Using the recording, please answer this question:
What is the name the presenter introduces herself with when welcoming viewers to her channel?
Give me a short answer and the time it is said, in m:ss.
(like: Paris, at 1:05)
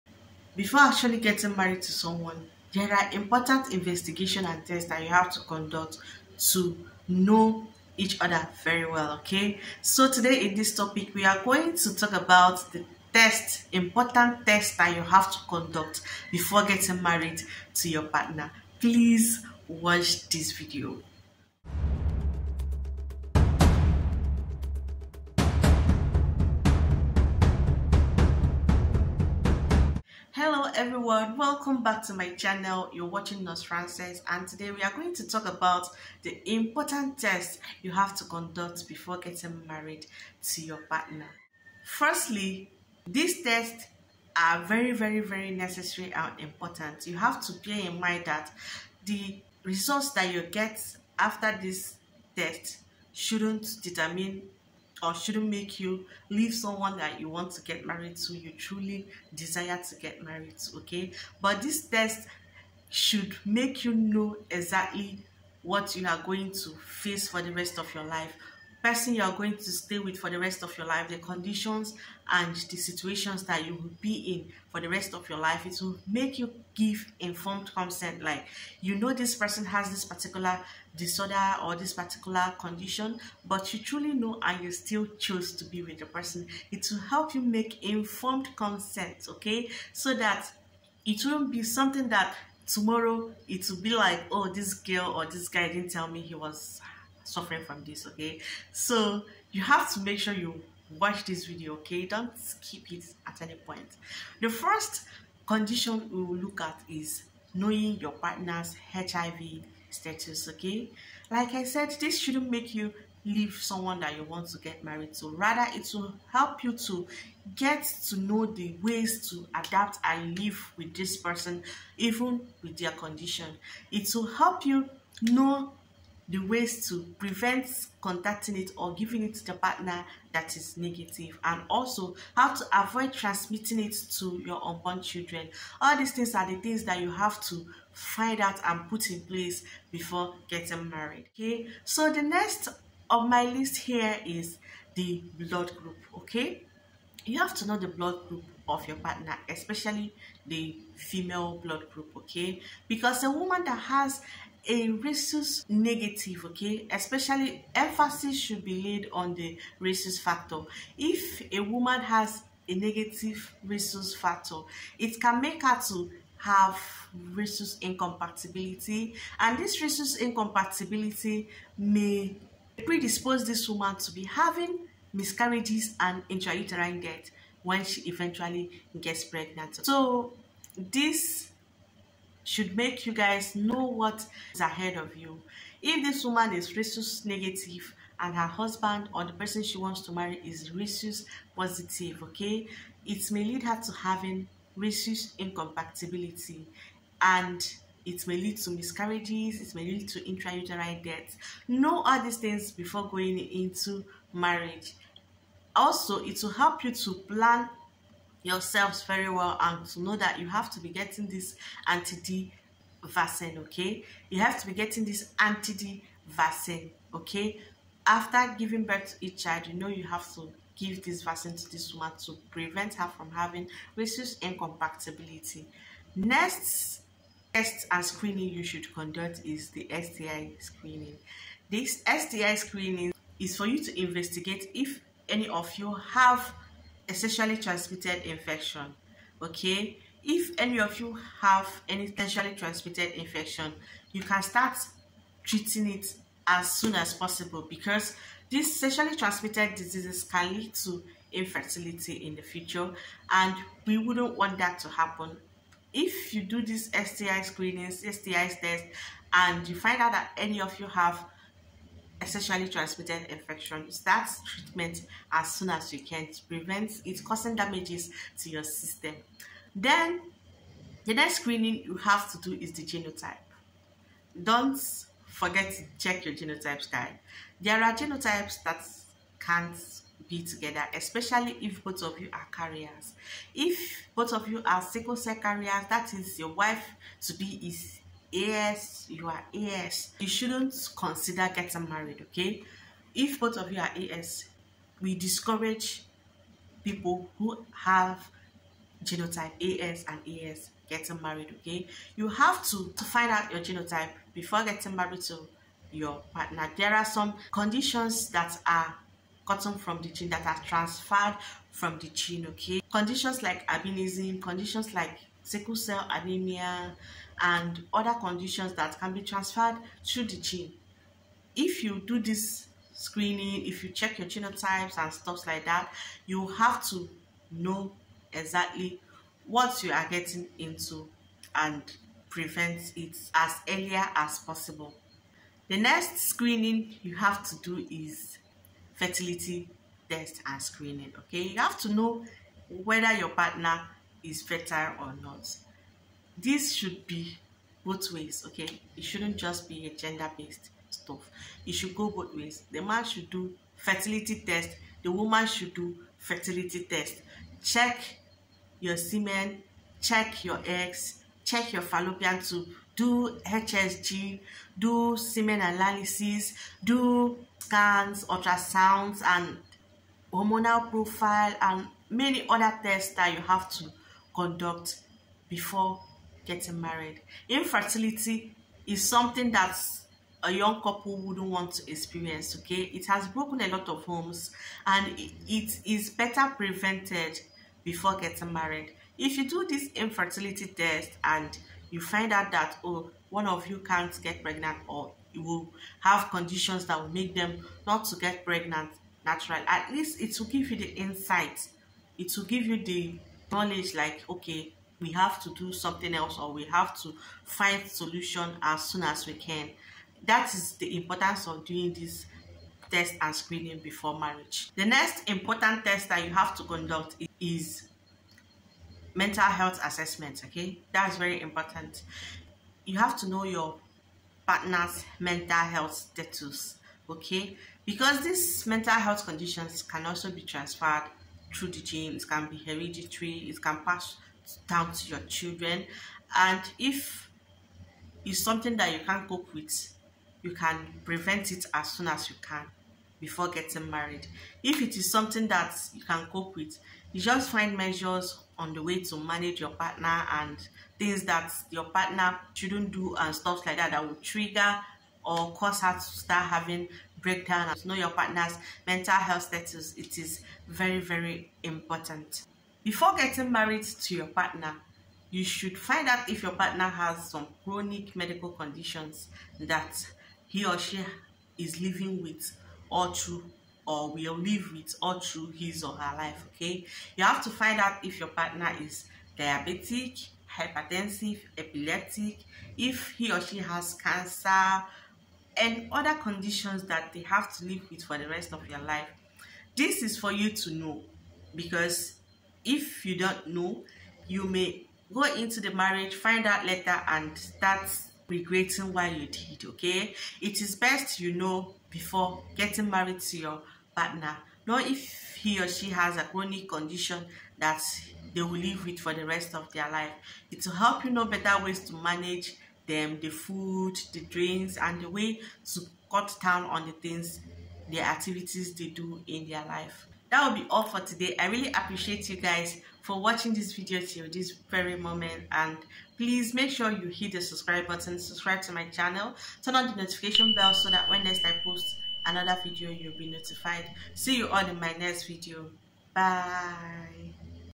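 Nurse Frances, at 0:33.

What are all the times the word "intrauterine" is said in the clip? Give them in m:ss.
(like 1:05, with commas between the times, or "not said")
2:56, 3:20.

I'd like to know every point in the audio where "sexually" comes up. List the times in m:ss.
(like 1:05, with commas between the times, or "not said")
3:57, 4:02, 4:08, 4:22.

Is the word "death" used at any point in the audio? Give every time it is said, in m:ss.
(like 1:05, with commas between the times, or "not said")
2:57, 3:21.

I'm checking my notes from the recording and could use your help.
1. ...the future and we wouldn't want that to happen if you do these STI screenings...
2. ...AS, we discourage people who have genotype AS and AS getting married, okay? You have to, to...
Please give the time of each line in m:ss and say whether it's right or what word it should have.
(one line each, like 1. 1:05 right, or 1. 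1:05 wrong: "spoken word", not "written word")
1. 4:12 right
2. 4:53 right.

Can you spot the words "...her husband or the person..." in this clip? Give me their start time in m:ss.
3:08.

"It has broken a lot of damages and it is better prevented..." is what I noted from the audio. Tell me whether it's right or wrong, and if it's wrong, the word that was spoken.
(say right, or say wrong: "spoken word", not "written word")
wrong: "homes", not "damages".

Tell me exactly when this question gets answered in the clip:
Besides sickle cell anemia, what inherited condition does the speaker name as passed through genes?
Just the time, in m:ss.
5:13.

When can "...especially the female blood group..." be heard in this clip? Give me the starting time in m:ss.
2:29.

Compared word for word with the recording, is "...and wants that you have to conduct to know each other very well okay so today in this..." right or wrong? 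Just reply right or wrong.
wrong.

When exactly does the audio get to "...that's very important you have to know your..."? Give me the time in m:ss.
7:00.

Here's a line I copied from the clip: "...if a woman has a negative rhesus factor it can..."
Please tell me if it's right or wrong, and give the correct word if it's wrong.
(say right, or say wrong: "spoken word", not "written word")
right.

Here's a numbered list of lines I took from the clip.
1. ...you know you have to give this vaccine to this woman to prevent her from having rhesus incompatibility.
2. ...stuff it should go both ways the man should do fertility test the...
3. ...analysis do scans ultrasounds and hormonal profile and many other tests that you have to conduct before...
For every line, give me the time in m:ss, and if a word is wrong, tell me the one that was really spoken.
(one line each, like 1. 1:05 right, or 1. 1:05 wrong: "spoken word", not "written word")
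1. 3:39 right
2. 5:50 right
3. 6:05 right.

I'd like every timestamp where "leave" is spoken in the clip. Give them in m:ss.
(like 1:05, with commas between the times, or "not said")
0:56, 1:53.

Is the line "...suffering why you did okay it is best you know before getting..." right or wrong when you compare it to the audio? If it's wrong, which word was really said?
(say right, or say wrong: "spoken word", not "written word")
wrong: "regretting", not "suffering".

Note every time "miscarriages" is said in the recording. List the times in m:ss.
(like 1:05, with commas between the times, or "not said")
2:55, 3:18.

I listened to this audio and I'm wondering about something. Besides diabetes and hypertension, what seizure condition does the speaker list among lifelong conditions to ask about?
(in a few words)
epileptic.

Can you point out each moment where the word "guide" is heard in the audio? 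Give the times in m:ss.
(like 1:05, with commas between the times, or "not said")
4:36.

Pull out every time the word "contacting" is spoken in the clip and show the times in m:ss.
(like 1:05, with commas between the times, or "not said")
2:07.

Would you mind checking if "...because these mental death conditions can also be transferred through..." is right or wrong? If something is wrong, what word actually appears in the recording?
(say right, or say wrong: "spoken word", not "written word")
wrong: "health", not "death".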